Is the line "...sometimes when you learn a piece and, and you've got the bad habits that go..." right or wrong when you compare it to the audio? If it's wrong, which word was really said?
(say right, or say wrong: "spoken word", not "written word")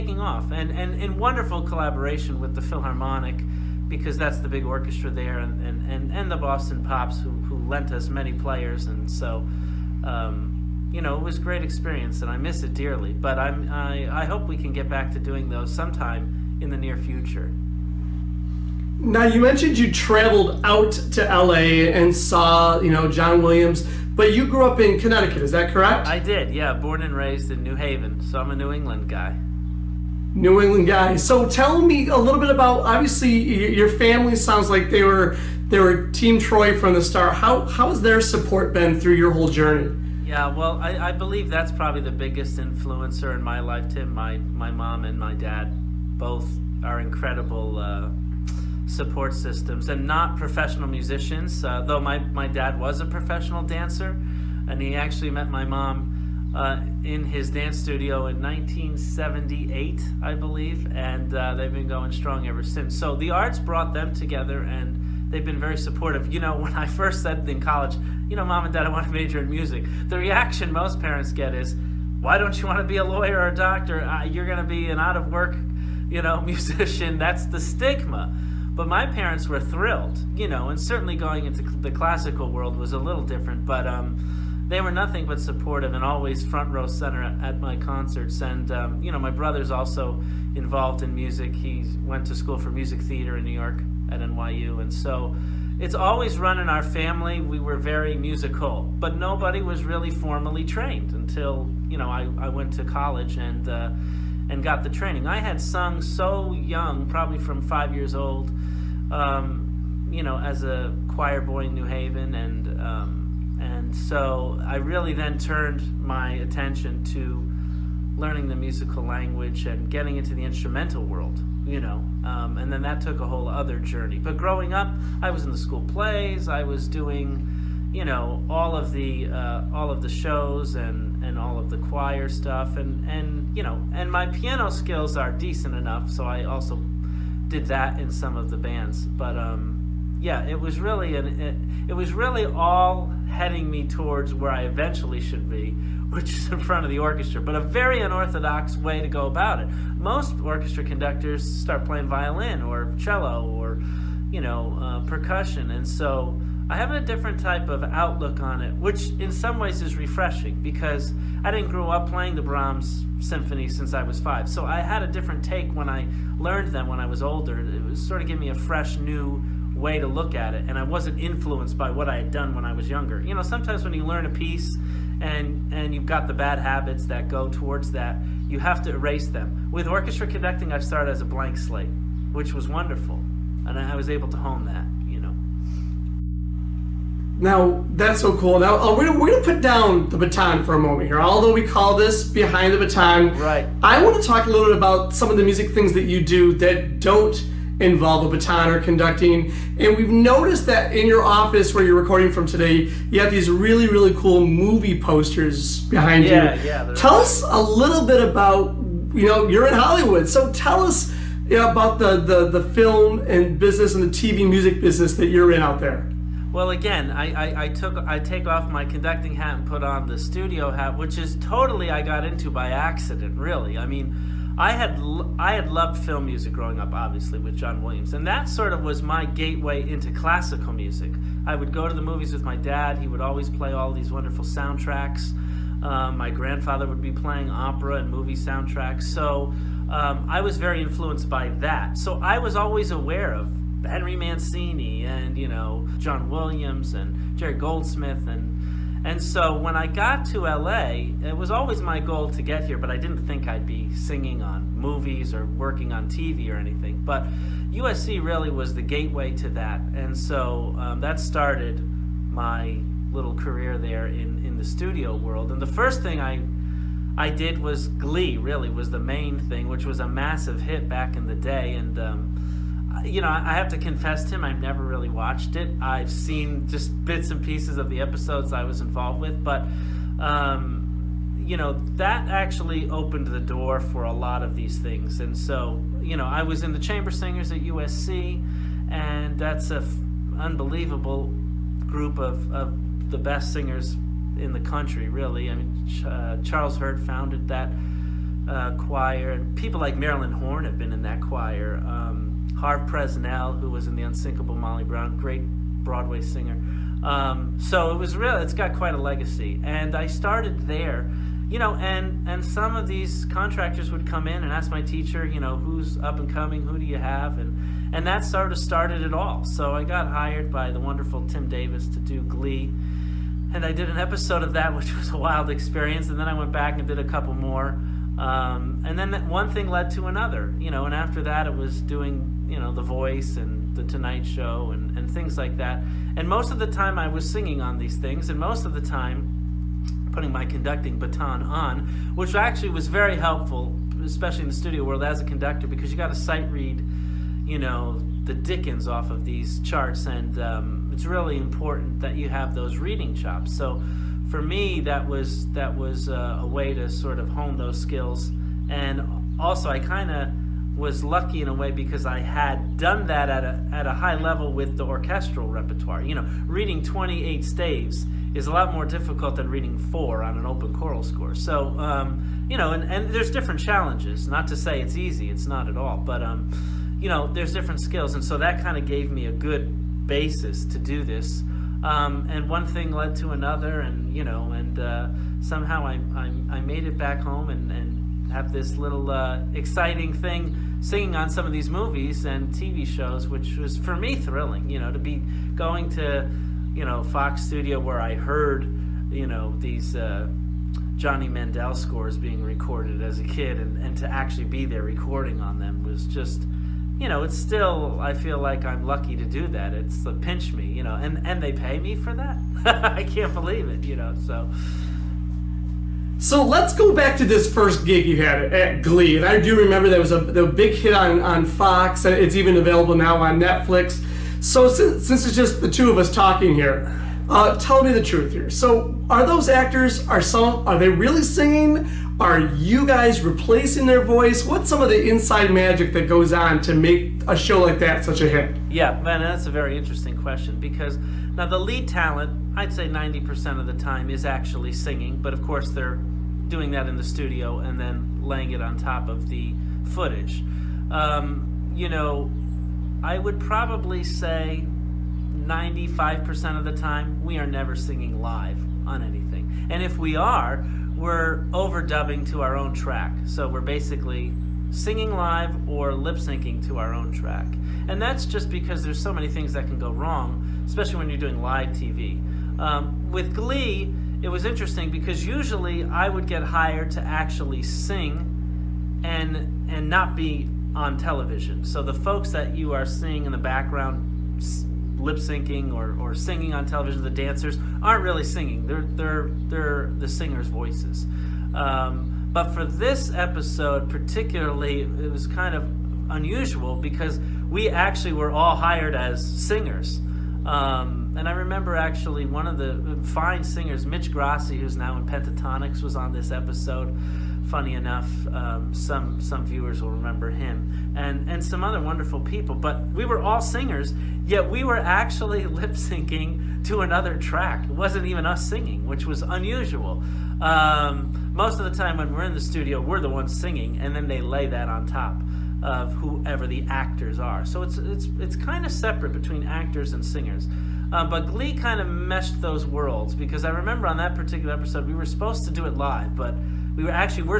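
right.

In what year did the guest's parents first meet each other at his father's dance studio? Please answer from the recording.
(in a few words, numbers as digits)
1978.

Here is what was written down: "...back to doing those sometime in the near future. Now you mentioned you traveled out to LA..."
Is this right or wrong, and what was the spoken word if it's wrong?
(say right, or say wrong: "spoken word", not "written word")
right.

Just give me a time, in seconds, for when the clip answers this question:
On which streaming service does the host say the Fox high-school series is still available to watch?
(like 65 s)
423 s.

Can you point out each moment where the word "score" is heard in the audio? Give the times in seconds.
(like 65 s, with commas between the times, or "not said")
371 s, 401 s.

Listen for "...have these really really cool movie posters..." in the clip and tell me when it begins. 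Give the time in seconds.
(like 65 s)
203 s.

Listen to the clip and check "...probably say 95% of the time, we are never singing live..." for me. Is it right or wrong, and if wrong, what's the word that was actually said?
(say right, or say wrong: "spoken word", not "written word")
right.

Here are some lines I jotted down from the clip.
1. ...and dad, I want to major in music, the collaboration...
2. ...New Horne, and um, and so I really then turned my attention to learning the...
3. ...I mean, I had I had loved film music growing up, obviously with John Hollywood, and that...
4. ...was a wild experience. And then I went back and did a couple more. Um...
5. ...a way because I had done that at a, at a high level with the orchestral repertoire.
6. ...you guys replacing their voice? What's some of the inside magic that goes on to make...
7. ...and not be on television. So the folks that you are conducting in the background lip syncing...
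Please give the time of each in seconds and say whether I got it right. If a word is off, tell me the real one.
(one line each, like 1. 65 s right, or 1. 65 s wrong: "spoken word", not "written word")
1. 68 s wrong: "reaction", not "collaboration"
2. 111 s wrong: "Haven", not "Horne"
3. 223 s wrong: "Williams", not "Hollywood"
4. 324 s right
5. 361 s right
6. 432 s right
7. 479 s wrong: "seeing", not "conducting".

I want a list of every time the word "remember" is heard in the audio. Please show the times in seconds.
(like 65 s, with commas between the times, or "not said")
419 s, 501 s, 509 s, 533 s.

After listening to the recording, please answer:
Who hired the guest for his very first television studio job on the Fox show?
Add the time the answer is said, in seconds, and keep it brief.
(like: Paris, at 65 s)
Tim Davis, at 321 s.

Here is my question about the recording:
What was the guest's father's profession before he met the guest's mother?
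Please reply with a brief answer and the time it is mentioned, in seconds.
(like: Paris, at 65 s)
Professional dancer, at 53 s.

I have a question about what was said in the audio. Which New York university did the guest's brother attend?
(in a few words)
NYU.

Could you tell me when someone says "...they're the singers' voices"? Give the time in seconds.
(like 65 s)
489 s.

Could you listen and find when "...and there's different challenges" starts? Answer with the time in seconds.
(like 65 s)
372 s.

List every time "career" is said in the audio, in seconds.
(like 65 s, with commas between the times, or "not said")
263 s.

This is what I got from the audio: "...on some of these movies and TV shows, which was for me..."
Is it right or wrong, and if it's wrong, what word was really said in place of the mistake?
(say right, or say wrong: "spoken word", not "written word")
right.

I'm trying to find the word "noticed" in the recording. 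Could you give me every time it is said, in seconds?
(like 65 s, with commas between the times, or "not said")
200 s.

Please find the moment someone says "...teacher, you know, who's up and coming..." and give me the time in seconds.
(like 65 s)
314 s.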